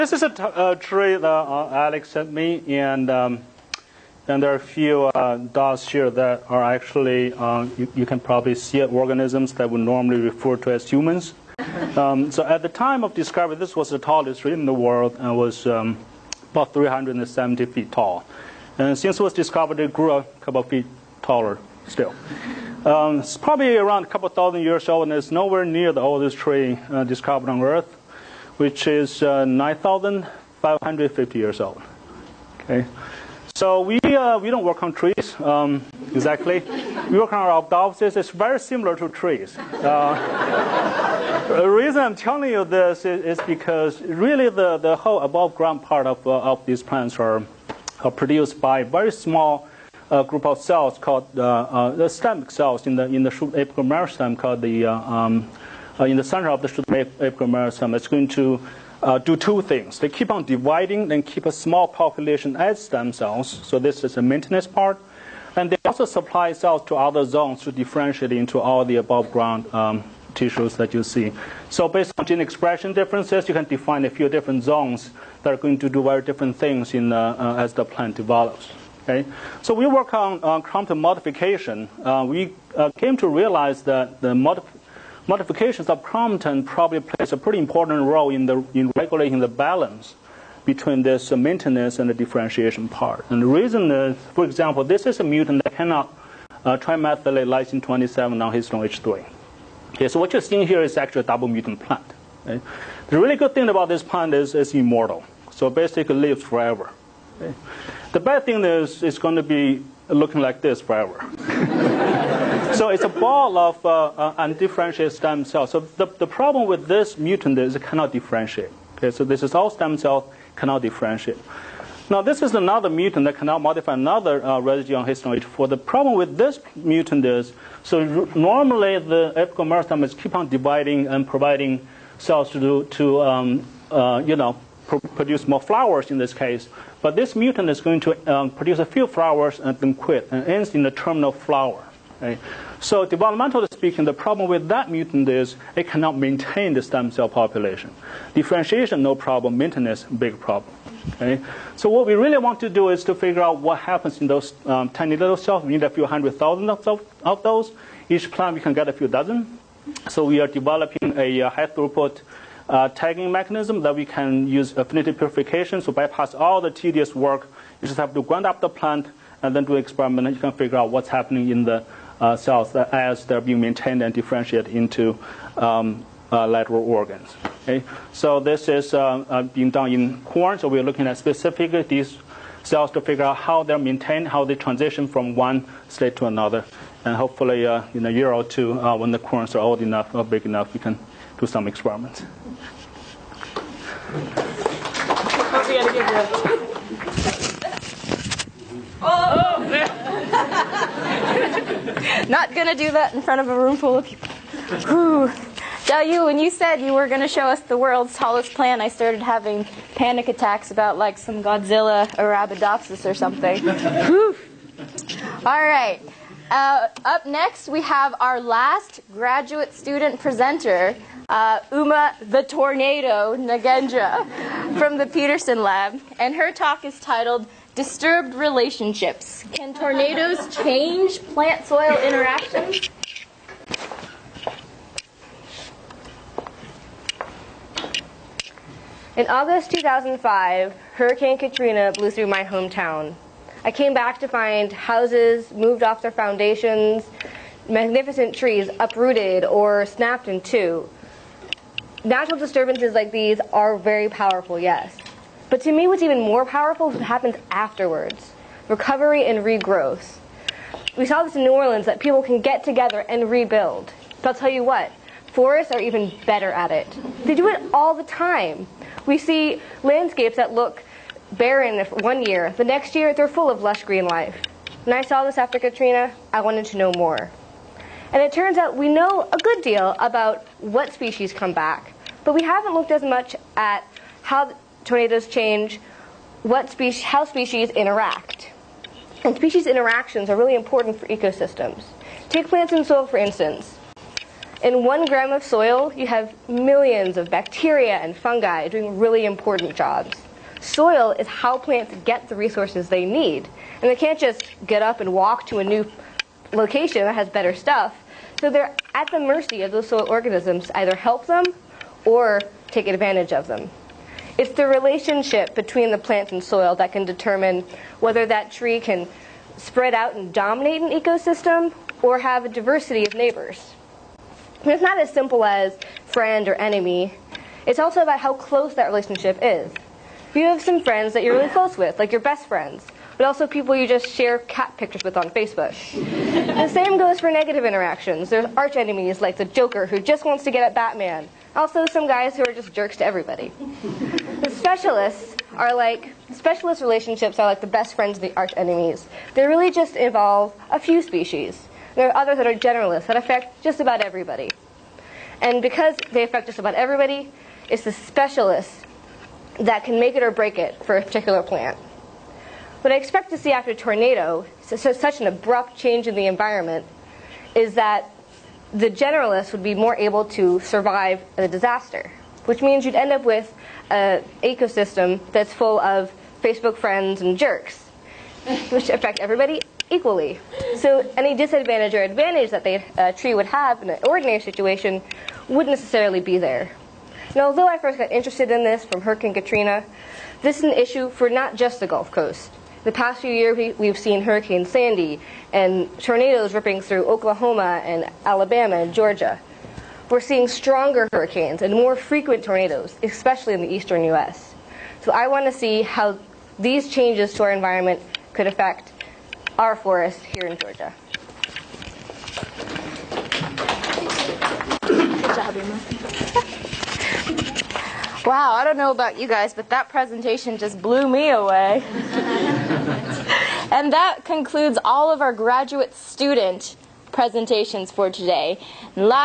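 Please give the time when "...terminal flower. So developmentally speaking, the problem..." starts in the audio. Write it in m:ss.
2:20.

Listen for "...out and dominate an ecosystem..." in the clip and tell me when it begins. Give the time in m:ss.
5:19.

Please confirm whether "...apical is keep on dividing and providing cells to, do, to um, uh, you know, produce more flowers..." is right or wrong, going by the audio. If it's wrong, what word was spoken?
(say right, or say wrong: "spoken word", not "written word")
right.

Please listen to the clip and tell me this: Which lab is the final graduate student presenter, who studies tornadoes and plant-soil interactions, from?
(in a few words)
Peterson Lab.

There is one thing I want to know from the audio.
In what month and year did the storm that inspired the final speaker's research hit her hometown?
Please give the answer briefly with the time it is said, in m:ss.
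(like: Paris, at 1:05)
August 2005, at 3:59.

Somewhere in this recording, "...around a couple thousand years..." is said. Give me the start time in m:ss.
0:23.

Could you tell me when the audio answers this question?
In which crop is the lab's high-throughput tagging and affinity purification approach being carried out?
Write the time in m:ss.
3:00.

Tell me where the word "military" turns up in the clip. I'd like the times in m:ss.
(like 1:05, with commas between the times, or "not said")
not said.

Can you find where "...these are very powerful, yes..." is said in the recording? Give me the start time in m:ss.
4:13.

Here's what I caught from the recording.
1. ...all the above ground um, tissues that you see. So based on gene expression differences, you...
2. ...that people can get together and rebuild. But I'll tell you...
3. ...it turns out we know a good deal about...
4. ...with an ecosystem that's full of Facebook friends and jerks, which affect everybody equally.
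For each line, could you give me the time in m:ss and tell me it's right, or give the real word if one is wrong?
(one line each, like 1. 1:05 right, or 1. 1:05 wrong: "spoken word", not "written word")
1. 1:08 right
2. 4:21 right
3. 4:38 right
4. 6:13 right.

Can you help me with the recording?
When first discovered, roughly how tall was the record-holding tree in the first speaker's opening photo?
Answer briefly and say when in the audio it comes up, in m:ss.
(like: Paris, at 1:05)
370 feet, at 0:16.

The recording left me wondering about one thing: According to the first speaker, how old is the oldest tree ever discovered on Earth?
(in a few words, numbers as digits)
9,550 years.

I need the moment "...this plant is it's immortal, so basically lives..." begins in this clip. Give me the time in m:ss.
1:43.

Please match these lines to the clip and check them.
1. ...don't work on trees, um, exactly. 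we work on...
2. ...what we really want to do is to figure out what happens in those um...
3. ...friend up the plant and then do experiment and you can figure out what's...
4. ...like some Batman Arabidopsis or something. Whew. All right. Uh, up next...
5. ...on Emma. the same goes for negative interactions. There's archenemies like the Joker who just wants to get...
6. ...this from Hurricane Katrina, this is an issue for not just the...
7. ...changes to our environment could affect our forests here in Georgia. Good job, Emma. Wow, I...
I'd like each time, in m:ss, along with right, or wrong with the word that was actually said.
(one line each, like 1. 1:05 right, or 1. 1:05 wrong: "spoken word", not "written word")
1. 0:34 right
2. 2:31 right
3. 2:48 wrong: "grind", not "friend"
4. 3:30 wrong: "Godzilla", not "Batman"
5. 5:35 wrong: "Facebook", not "Emma"
6. 6:28 right
7. 6:46 right.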